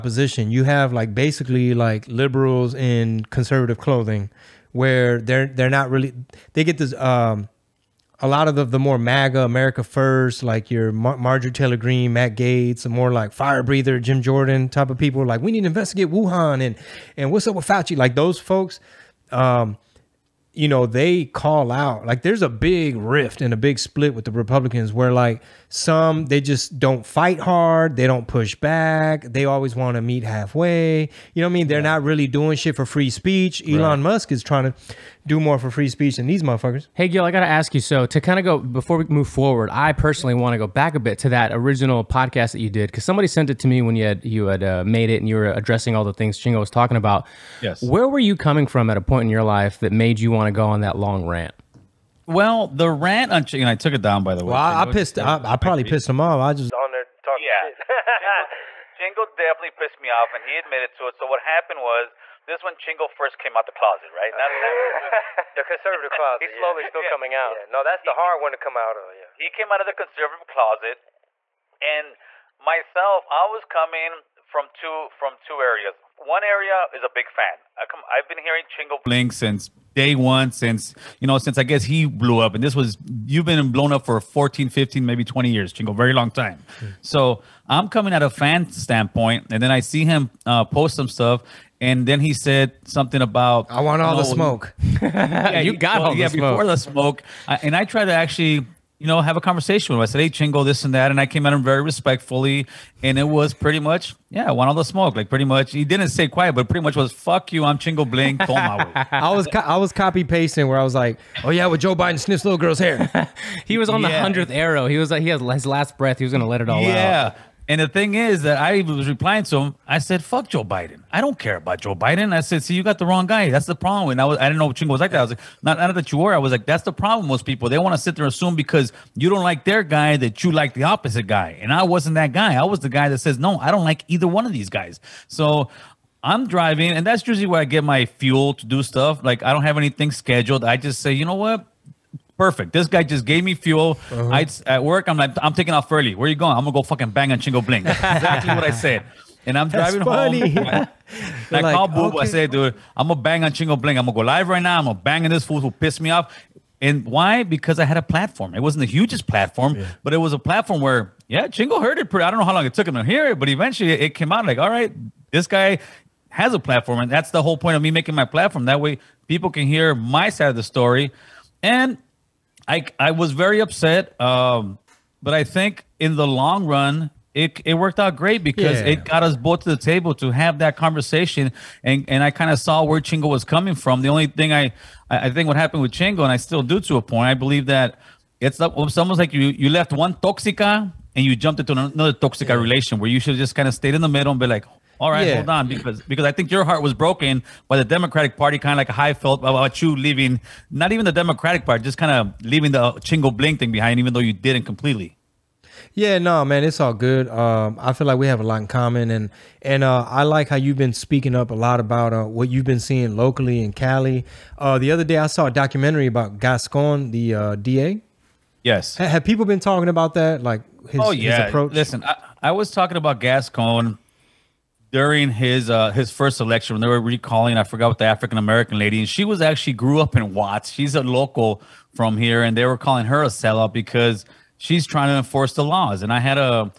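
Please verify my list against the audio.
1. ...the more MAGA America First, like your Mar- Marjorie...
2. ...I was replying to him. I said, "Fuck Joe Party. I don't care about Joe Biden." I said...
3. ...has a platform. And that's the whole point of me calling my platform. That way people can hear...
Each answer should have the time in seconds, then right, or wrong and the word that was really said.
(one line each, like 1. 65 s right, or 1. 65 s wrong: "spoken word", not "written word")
1. 8 s right
2. 118 s wrong: "Biden", not "Party"
3. 166 s wrong: "making", not "calling".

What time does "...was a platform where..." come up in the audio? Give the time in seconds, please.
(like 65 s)
160 s.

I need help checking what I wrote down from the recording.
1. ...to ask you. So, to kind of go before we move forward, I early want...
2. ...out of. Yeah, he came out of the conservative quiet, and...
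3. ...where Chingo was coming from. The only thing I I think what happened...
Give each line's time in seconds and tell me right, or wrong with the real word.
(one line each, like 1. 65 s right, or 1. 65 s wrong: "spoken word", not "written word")
1. 37 s wrong: "personally", not "early"
2. 68 s wrong: "closet", not "quiet"
3. 182 s right.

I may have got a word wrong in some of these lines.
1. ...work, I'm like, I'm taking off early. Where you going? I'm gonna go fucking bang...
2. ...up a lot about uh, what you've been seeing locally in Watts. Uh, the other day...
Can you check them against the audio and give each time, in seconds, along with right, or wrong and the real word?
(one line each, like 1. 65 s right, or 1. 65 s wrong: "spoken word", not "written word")
1. 144 s right
2. 211 s wrong: "Cali", not "Watts".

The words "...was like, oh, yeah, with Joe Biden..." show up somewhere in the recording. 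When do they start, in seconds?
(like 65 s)
110 s.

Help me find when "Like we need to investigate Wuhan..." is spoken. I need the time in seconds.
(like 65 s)
15 s.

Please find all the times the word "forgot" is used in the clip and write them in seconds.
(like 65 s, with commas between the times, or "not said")
227 s.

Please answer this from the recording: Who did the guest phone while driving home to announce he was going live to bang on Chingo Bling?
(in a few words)
Boob.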